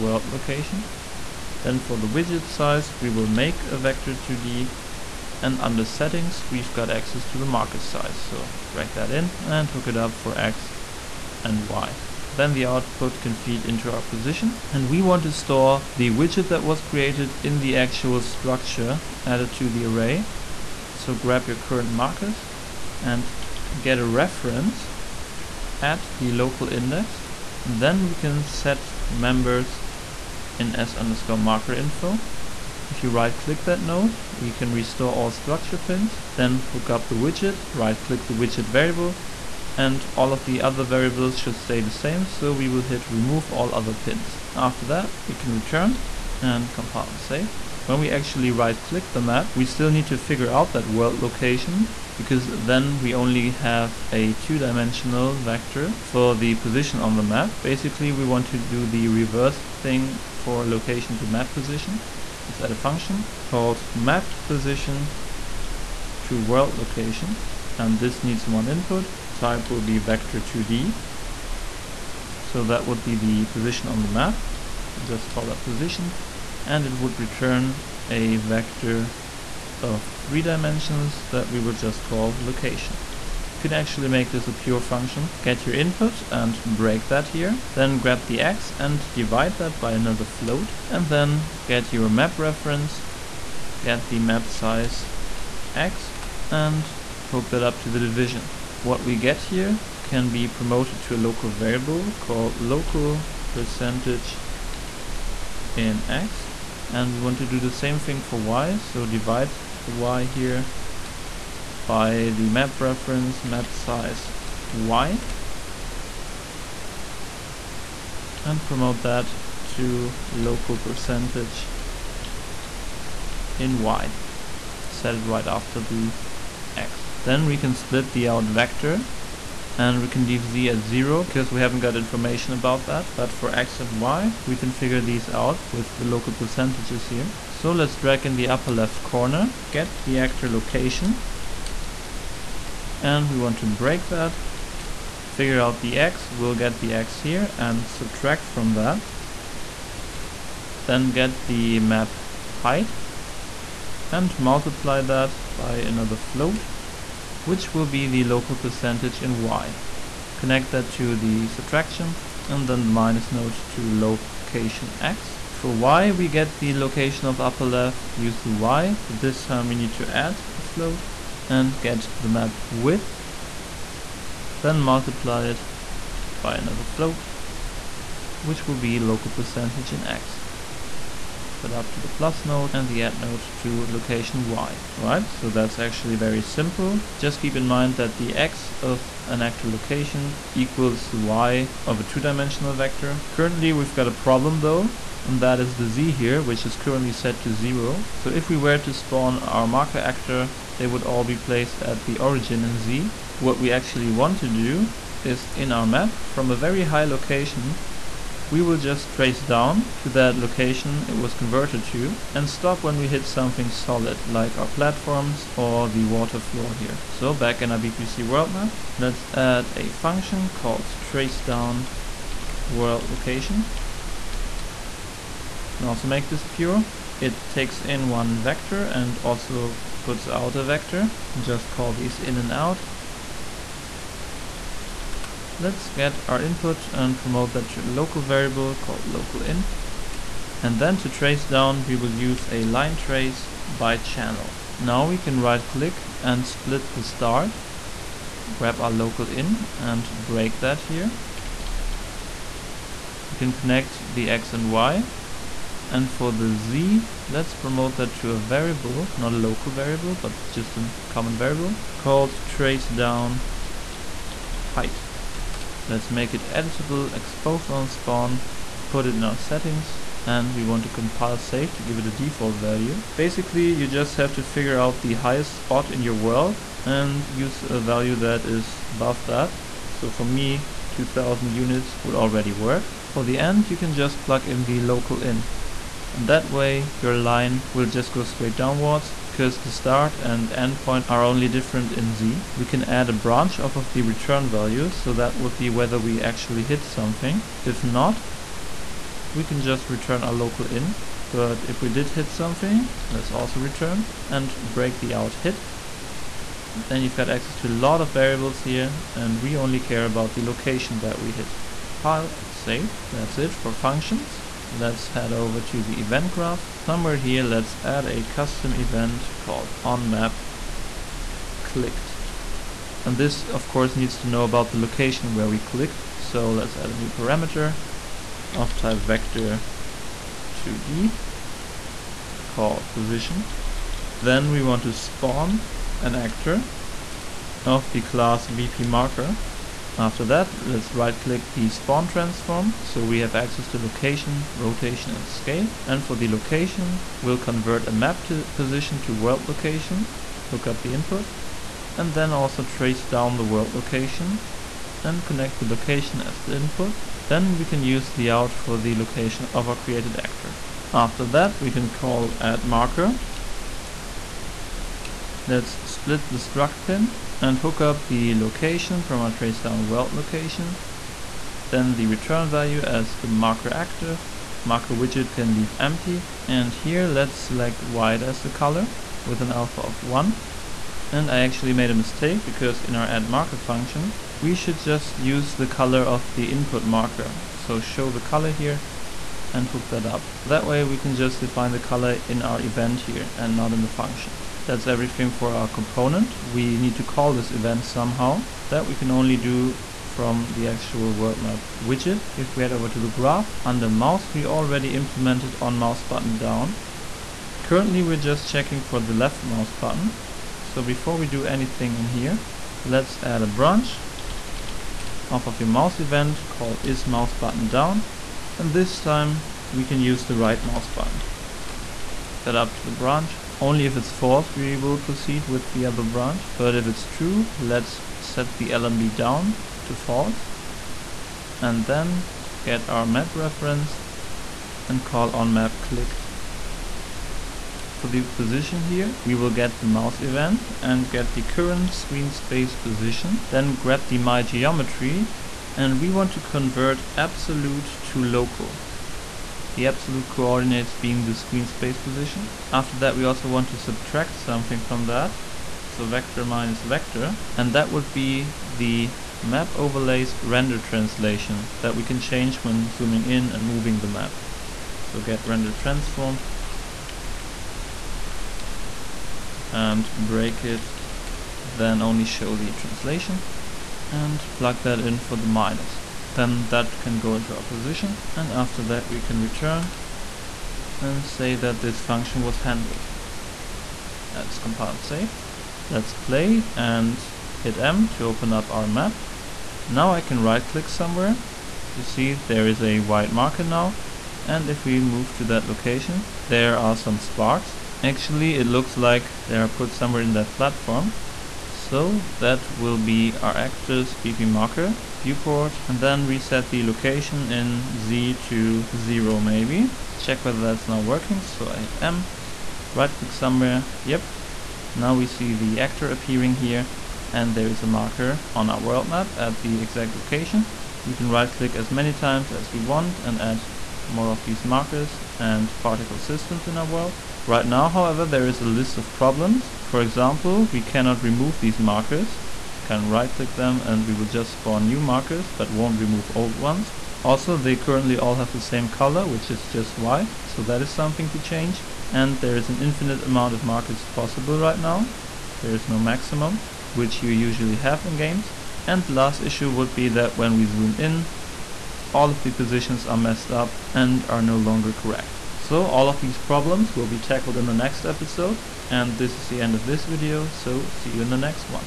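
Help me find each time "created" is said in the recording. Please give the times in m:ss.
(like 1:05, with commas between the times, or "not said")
0:16, 5:59.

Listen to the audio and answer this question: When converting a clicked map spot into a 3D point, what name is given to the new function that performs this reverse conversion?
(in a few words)
map position to world location.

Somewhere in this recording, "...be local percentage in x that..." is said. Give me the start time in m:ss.
2:58.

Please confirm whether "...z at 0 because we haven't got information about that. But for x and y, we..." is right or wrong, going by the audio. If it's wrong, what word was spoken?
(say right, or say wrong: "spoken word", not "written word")
right.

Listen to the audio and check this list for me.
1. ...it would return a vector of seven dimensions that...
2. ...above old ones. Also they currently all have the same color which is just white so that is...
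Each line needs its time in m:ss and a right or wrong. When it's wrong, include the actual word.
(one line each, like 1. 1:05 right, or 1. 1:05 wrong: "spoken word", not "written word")
1. 1:16 wrong: "three", not "seven"
2. 8:55 wrong: "remove", not "above".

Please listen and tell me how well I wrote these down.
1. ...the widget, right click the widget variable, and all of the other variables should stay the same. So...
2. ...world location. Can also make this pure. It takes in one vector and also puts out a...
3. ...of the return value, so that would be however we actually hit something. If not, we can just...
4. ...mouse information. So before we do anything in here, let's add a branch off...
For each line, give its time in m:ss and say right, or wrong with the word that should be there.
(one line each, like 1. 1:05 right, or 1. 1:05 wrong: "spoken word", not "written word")
1. 0:37 right
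2. 3:42 right
3. 4:53 wrong: "whether", not "however"
4. 6:49 wrong: "button", not "information".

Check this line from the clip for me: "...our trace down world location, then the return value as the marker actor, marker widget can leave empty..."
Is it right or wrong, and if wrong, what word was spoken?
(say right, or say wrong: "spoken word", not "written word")
right.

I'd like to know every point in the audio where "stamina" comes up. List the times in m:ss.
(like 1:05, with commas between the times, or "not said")
not said.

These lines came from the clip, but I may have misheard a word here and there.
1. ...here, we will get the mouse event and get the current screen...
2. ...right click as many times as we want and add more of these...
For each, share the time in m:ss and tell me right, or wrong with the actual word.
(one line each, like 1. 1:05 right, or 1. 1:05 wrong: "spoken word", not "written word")
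1. 7:18 right
2. 8:41 right.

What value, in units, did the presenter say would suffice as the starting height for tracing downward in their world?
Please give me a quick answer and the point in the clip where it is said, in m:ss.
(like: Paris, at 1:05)
2000, at 4:40.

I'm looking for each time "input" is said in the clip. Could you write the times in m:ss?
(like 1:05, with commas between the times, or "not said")
1:08, 1:25, 3:56, 5:50, 5:56, 6:26.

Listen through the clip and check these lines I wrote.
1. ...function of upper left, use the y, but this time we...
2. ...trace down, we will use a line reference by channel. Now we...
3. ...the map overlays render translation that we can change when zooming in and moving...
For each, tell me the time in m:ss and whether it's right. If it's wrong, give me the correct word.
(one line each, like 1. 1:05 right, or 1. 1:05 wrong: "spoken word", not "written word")
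1. 2:46 wrong: "location", not "function"
2. 4:01 wrong: "trace", not "reference"
3. 7:38 right.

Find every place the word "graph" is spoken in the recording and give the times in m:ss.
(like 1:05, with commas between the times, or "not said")
5:16, 6:43.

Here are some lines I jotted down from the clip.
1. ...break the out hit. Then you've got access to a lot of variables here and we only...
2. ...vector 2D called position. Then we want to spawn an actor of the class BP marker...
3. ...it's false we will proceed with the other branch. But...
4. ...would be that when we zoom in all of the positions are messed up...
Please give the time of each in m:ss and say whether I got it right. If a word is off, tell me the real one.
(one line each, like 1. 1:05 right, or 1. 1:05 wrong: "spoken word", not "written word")
1. 5:04 right
2. 5:28 right
3. 7:03 right
4. 9:09 right.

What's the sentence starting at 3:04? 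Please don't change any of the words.
All right, so that's actually very simple.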